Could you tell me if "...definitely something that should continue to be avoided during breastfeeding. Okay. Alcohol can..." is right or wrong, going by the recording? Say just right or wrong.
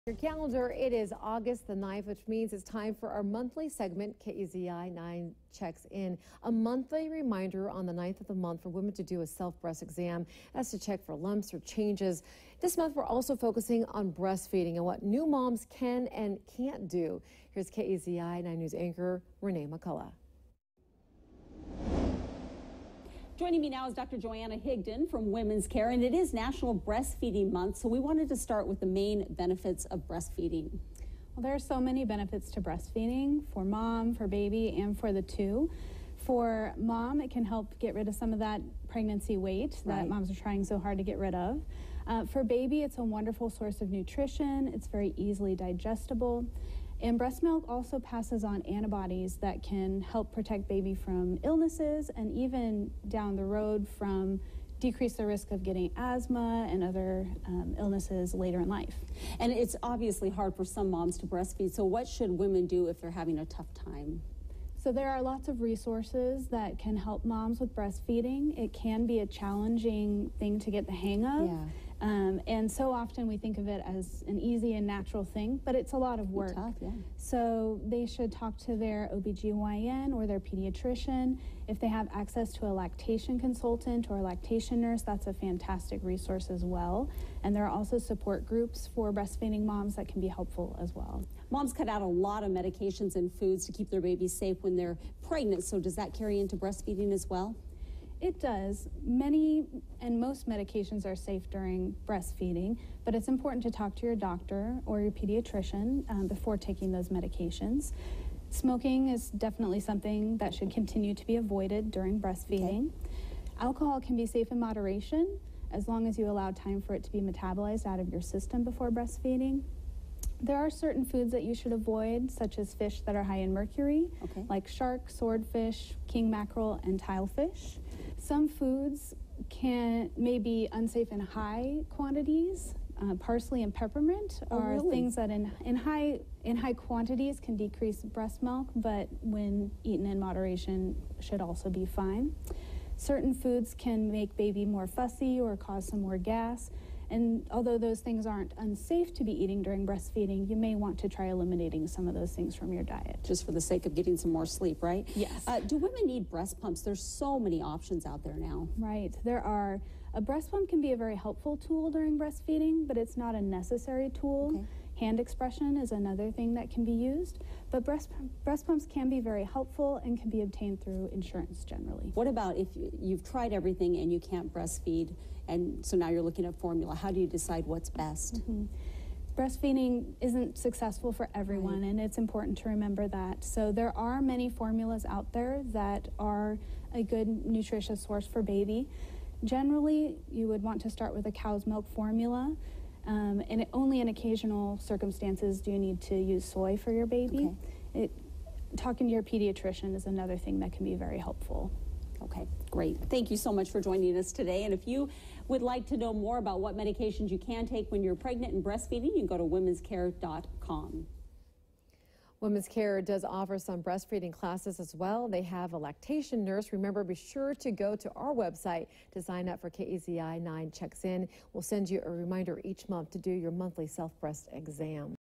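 right.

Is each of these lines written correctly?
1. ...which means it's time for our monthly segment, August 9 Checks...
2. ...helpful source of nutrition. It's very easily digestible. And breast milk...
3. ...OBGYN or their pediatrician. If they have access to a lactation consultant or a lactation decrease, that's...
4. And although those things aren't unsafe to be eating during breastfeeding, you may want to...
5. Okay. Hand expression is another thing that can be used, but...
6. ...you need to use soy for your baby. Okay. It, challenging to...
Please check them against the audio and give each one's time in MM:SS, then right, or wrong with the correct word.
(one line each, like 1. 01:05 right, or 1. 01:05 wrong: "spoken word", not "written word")
1. 00:02 wrong: "KEZI", not "August"
2. 00:43 wrong: "wonderful", not "helpful"
3. 01:19 wrong: "nurse", not "decrease"
4. 02:27 right
5. 02:44 right
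6. 03:15 wrong: "talking", not "challenging".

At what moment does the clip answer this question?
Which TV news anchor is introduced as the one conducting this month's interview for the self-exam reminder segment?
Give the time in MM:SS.
00:19.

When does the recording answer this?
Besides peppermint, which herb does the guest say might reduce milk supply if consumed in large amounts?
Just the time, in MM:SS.
02:13.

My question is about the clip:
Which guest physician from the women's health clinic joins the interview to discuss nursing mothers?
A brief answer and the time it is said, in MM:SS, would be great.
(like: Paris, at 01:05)
Dr. Johanna Higdon, at 00:24.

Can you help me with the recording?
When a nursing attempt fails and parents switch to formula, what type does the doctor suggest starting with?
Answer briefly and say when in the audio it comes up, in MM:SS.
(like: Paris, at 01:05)
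Cow's milk formula, at 03:11.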